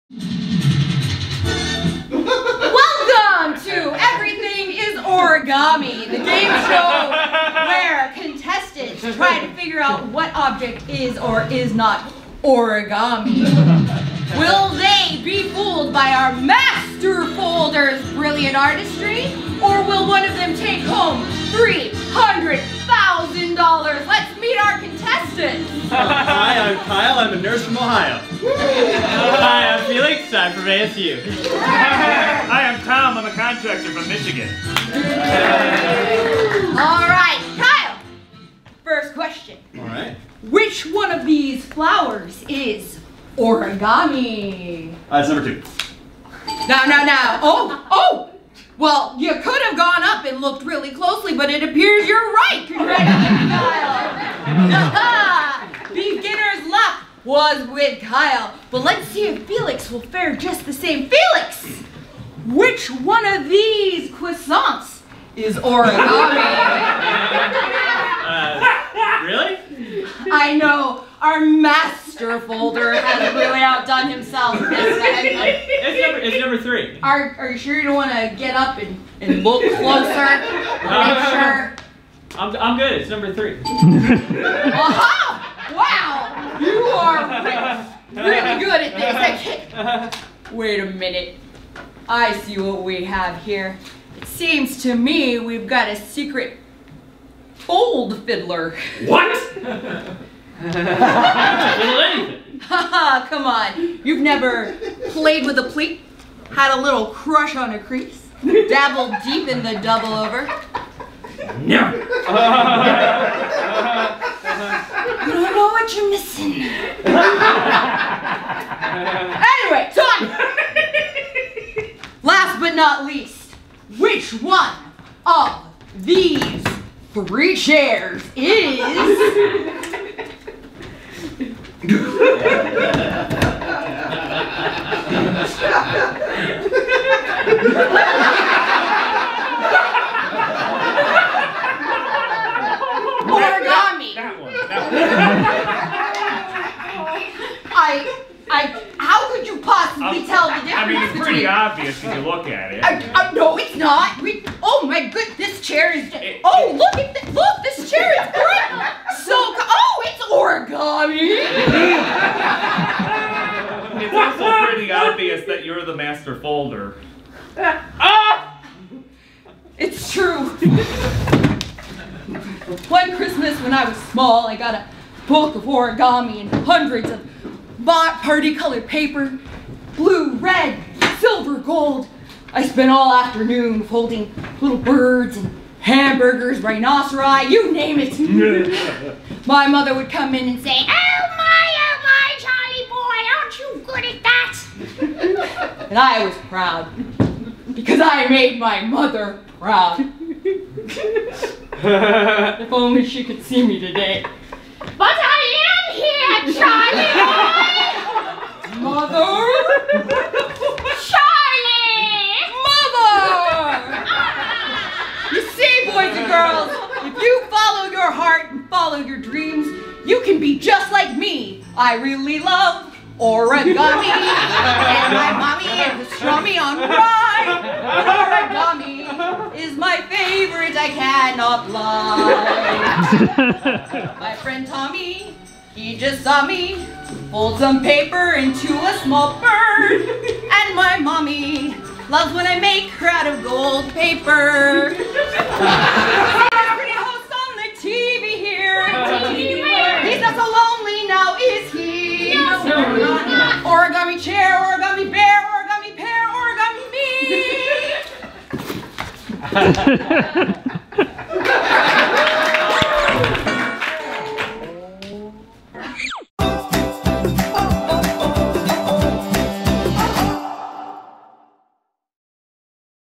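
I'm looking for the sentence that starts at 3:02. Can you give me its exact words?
I spent all afternoon folding little birds and hamburgers, rhinoceri, you name it.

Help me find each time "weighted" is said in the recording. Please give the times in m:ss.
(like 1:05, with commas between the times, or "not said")
not said.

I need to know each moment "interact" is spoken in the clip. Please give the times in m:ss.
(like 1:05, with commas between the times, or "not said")
not said.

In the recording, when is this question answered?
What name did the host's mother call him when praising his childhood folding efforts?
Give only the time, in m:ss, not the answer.
3:13.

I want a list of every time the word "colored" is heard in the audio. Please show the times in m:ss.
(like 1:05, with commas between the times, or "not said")
2:58.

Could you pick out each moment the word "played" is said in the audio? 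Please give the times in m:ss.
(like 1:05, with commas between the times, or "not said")
1:45.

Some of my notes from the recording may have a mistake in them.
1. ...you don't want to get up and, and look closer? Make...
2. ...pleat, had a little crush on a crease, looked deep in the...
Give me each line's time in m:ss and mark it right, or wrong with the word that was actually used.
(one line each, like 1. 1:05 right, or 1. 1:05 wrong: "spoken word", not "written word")
1. 1:17 right
2. 1:45 wrong: "dabbled", not "looked".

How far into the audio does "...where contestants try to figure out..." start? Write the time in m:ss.
0:07.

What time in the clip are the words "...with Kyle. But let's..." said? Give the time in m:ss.
0:57.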